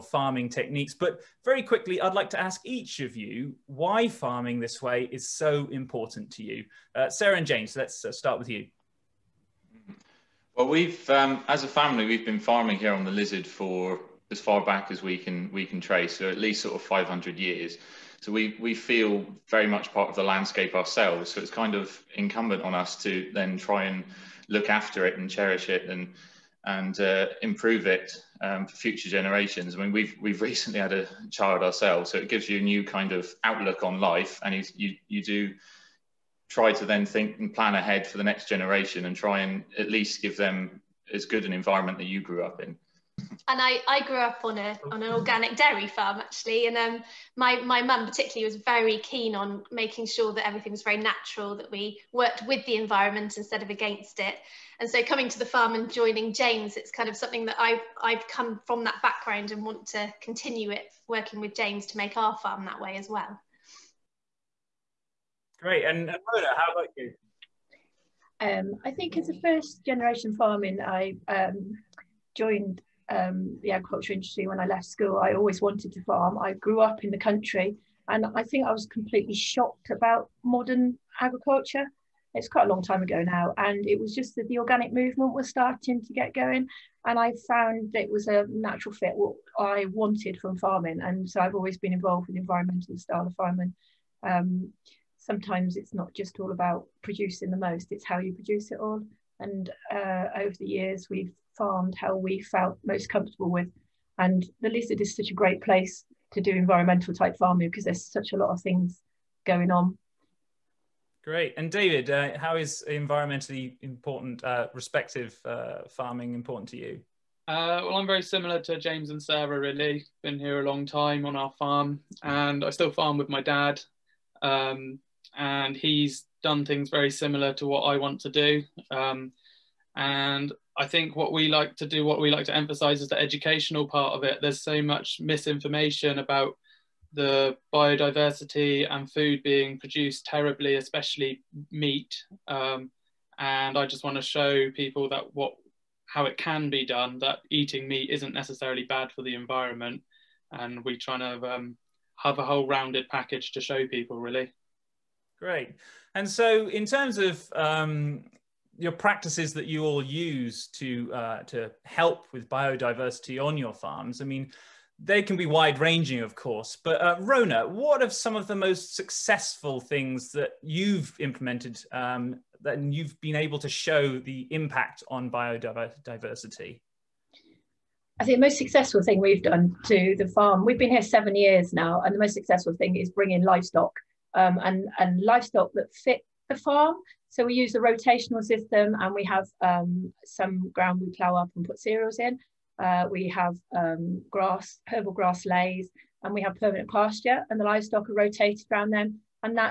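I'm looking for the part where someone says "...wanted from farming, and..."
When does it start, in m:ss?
1:29.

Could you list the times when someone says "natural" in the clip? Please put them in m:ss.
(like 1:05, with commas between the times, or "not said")
0:50, 1:28.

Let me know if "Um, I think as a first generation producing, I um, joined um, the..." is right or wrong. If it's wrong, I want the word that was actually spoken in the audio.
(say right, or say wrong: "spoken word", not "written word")
wrong: "farming", not "producing".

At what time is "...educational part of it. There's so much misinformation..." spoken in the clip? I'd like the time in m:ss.
2:13.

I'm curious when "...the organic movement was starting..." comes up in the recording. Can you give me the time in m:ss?
1:24.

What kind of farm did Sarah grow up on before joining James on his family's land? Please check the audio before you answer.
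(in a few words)
organic dairy farm.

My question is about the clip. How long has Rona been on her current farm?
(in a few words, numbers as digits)
7 years.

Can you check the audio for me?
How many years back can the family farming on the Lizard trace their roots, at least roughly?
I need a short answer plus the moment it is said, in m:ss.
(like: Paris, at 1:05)
500 years, at 0:16.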